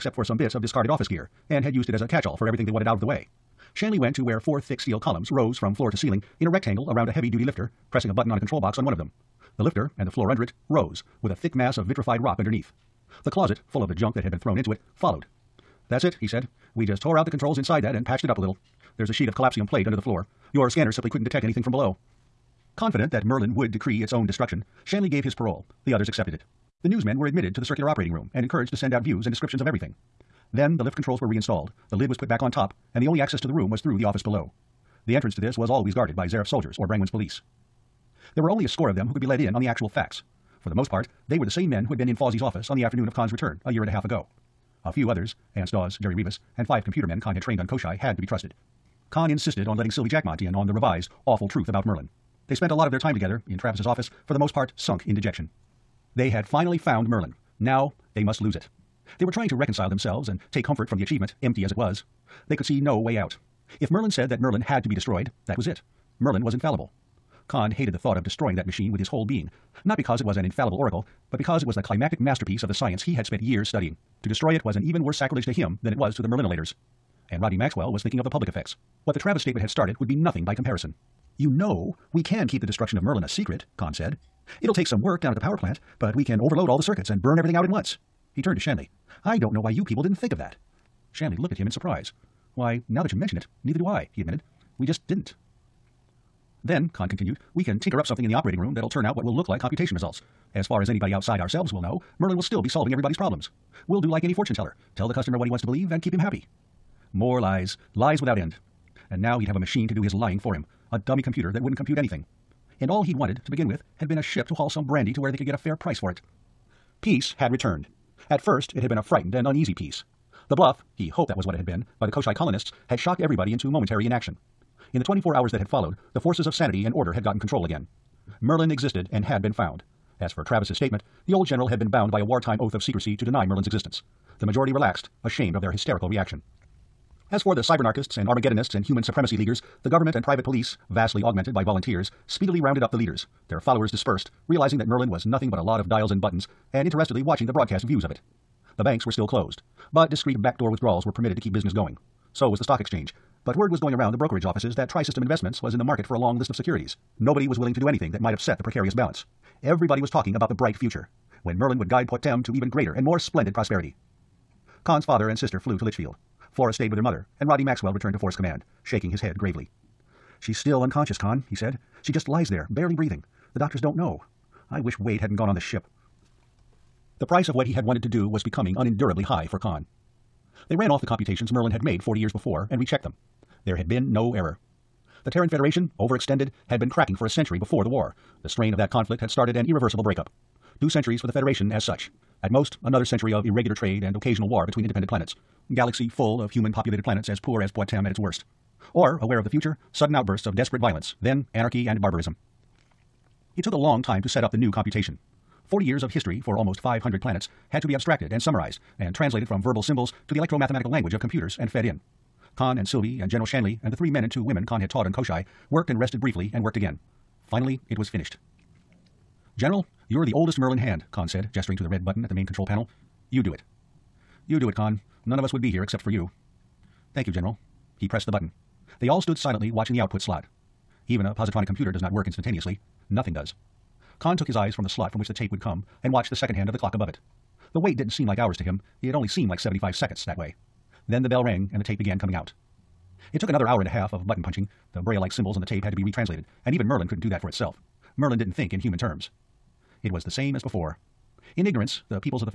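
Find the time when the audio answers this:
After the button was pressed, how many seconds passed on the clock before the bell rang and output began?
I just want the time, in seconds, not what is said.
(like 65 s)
239 s.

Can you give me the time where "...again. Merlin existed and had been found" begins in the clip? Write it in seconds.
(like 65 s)
127 s.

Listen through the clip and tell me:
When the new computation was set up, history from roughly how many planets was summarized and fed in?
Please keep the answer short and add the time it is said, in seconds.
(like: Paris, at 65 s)
500, at 206 s.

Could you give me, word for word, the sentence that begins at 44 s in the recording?
A few others, Anse Dawes, Jerry Rivas, and five computer men Conn had trained on Koshchei had to be trusted.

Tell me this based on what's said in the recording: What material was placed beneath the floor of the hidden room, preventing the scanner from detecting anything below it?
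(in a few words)
collapsium plate.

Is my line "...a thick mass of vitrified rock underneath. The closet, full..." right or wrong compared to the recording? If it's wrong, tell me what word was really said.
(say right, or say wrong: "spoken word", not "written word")
right.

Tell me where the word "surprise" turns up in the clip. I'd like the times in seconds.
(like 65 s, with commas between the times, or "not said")
91 s.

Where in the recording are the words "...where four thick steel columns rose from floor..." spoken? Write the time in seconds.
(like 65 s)
4 s.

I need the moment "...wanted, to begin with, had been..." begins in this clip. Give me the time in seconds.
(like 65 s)
113 s.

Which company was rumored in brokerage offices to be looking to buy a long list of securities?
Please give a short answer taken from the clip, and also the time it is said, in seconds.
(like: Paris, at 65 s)
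Tri System Investments, at 154 s.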